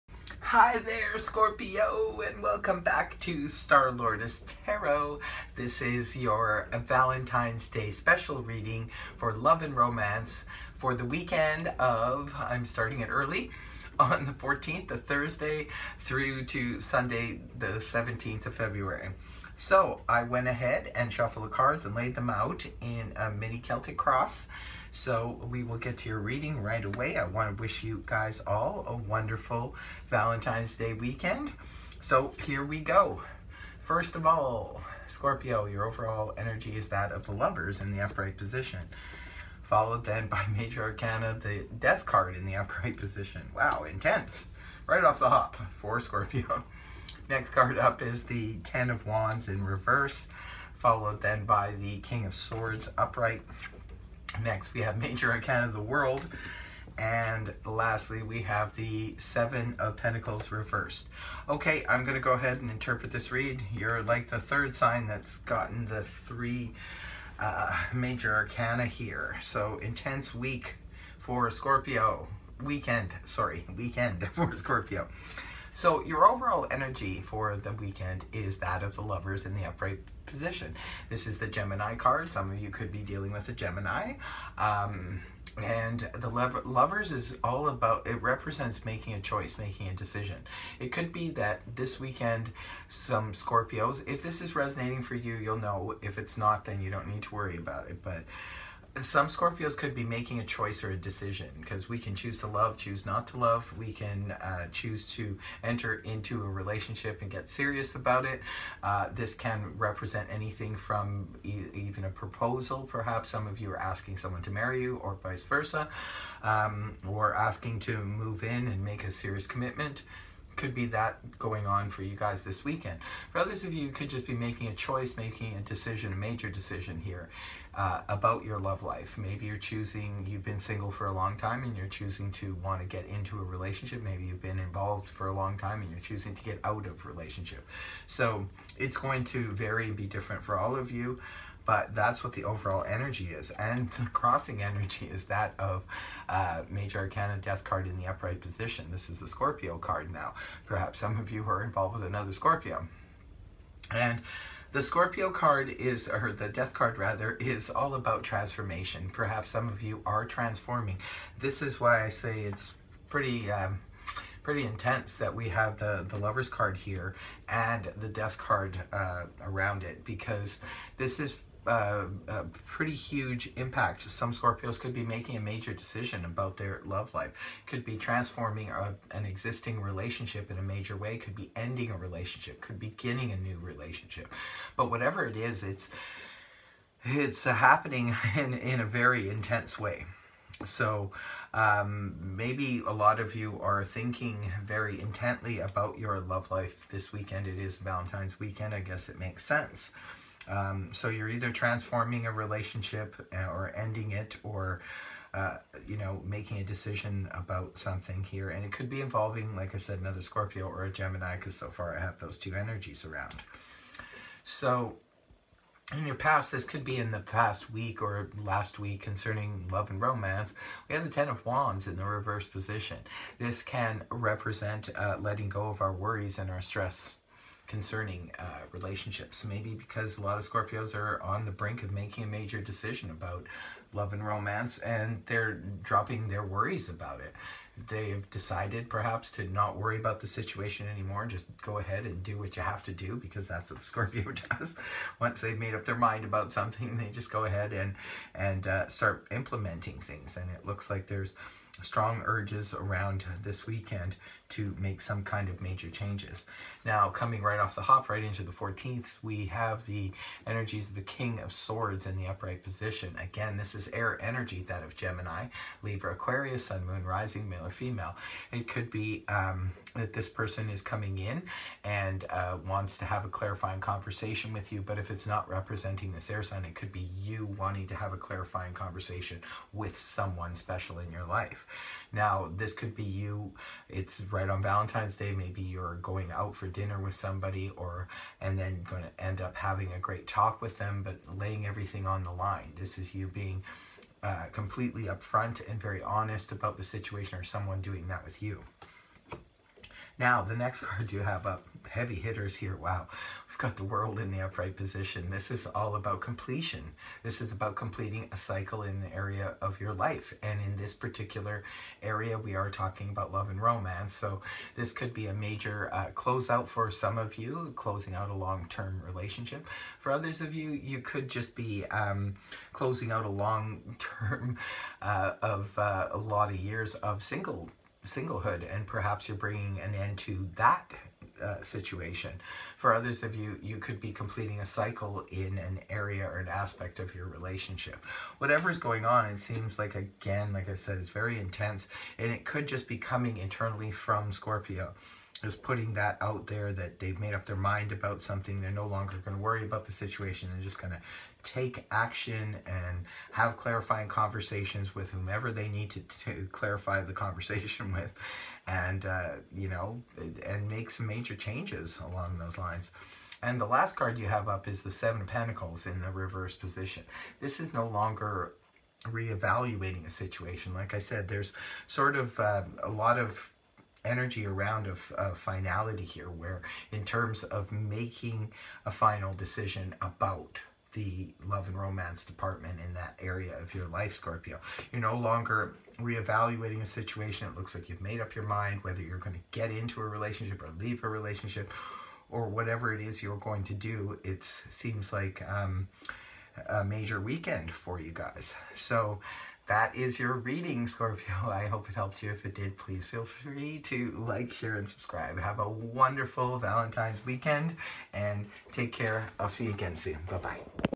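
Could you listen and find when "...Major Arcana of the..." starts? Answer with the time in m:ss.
0:54.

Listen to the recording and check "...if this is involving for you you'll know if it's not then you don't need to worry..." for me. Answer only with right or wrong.
wrong.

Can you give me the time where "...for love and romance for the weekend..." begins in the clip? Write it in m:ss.
0:09.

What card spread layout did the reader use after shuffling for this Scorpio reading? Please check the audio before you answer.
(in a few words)
Mini Celtic cross.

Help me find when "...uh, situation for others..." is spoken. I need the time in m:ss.
5:31.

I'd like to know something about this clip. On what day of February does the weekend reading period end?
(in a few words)
17th.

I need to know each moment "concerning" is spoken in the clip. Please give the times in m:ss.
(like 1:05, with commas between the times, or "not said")
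3:39, 3:47.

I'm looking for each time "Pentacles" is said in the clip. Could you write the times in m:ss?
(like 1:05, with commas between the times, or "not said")
0:59, 6:05.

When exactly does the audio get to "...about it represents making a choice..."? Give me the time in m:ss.
1:27.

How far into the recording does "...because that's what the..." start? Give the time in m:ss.
4:03.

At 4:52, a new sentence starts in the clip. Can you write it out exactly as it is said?
This is you being uh, completely upfront and very honest about the situation or someone doing that with you.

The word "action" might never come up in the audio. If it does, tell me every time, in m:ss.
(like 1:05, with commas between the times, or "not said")
5:51.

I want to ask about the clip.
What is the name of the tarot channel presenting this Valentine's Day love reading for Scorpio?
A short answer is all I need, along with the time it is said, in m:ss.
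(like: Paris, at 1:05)
Star Lordess Tarot, at 0:03.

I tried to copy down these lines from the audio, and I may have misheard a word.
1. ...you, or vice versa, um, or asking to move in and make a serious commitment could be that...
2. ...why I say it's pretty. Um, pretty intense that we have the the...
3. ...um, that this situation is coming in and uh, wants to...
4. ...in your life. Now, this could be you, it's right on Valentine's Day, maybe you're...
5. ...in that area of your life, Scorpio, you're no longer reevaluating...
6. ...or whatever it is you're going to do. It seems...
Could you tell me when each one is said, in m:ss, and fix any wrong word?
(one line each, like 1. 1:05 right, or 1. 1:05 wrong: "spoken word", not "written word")
1. 1:54 right
2. 2:41 right
3. 4:29 wrong: "person", not "situation"
4. 4:40 right
5. 6:22 right
6. 6:32 right.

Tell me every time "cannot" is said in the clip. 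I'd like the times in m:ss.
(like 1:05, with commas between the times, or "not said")
not said.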